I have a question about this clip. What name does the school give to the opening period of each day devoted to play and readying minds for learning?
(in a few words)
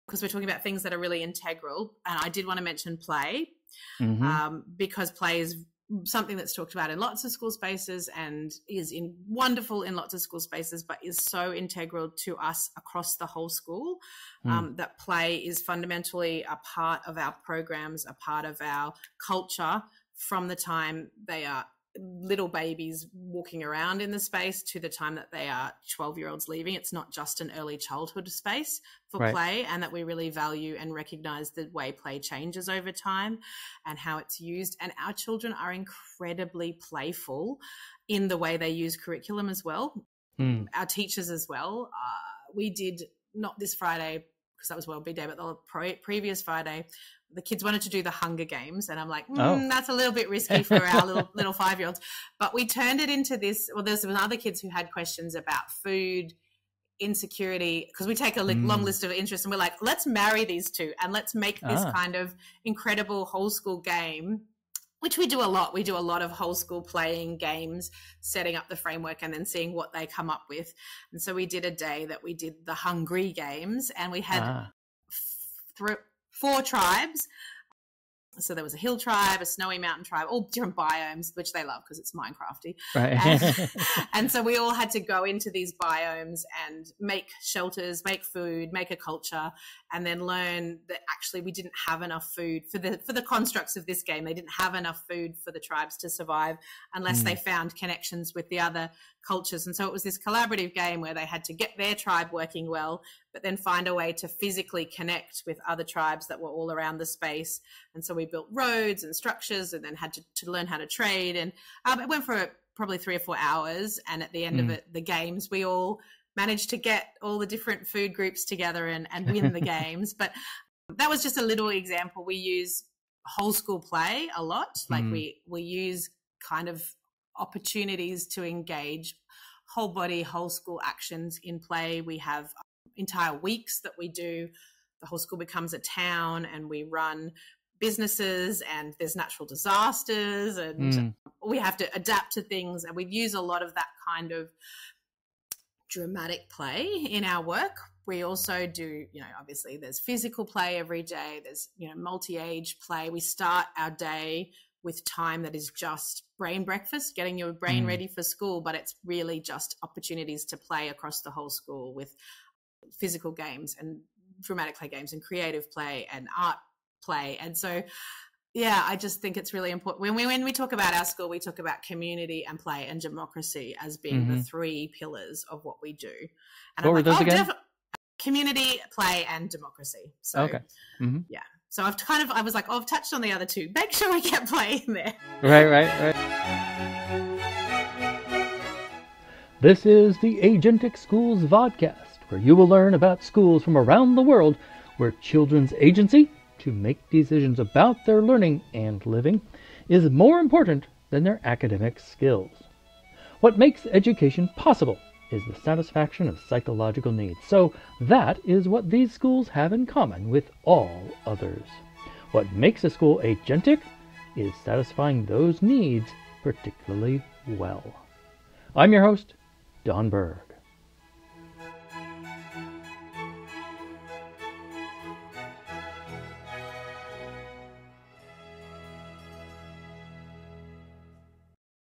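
brain breakfast.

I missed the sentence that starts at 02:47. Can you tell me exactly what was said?
And so, yeah, I just think it's really important.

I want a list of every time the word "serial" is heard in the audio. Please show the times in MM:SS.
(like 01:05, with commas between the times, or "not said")
not said.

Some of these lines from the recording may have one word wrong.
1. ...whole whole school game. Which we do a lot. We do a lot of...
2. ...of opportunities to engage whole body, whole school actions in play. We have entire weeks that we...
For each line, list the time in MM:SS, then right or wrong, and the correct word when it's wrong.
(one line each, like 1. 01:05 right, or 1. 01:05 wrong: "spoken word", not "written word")
1. 01:02 wrong: "incredible", not "whole"
2. 02:06 right.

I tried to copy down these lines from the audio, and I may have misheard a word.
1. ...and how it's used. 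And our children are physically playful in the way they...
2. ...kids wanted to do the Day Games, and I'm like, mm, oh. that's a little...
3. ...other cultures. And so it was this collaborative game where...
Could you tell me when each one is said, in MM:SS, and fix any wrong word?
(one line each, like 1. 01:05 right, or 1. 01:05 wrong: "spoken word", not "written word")
1. 00:33 wrong: "incredibly", not "physically"
2. 00:47 wrong: "Hunger", not "Day"
3. 01:38 right.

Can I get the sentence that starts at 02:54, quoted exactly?
the three pillars of what we do.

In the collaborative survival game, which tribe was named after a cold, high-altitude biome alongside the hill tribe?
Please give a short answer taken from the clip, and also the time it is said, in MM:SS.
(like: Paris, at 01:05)
snowy mountain tribe, at 01:19.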